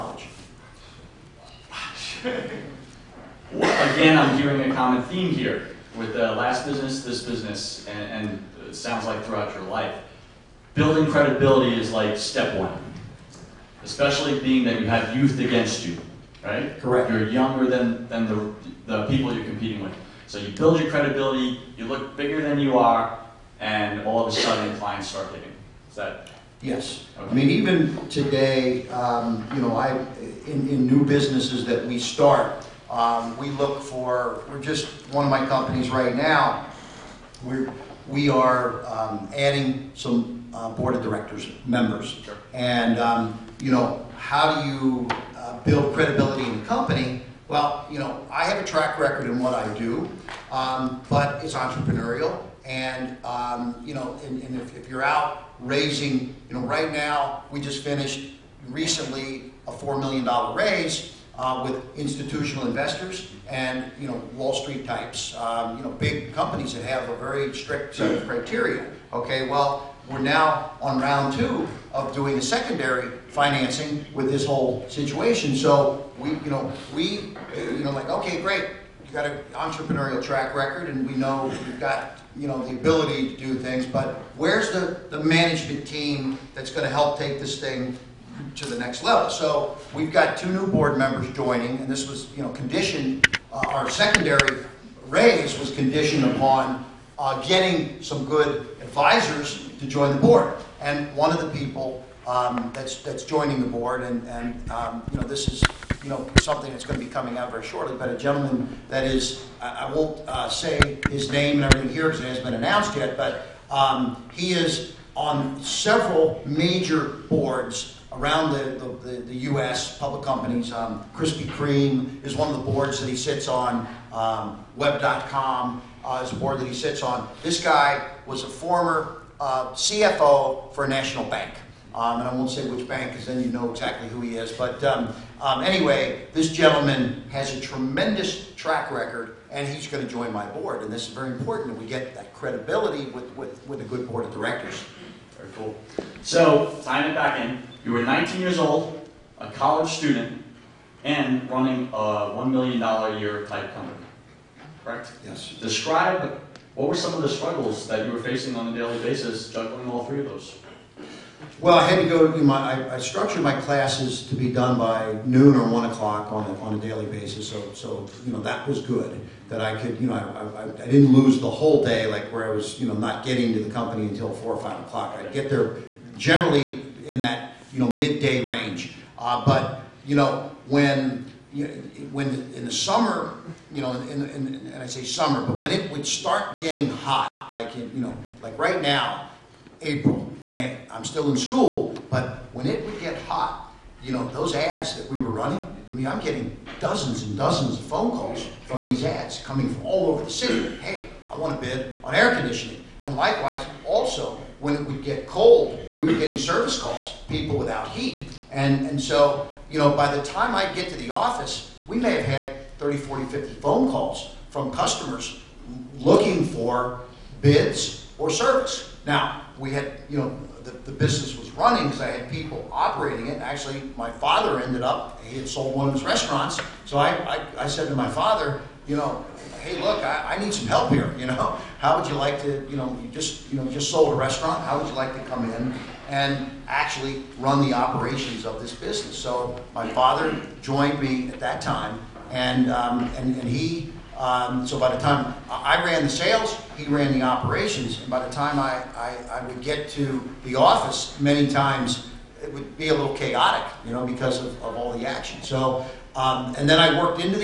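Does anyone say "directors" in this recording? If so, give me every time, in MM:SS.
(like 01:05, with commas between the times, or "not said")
00:41, 02:24.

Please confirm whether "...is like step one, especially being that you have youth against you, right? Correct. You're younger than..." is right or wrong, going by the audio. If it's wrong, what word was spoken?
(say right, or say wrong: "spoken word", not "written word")
right.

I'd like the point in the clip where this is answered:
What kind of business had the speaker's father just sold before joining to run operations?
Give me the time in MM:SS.
03:46.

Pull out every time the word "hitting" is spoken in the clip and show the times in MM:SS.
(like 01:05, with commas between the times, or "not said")
00:25.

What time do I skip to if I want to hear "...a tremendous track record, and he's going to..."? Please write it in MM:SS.
02:17.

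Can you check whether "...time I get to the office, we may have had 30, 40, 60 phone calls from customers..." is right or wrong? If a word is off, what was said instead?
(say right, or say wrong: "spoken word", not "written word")
wrong: "50", not "60".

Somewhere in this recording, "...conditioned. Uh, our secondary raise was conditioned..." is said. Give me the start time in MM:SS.
01:32.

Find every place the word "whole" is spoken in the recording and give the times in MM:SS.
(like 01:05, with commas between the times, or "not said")
01:14, 02:51.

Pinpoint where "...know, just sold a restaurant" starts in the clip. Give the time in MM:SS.
03:53.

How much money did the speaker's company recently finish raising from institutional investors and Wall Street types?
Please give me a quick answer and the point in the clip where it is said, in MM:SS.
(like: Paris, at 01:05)
$4 million, at 00:59.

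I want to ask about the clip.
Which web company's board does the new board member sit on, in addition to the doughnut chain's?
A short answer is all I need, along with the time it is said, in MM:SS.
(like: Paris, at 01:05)
Web.com, at 02:04.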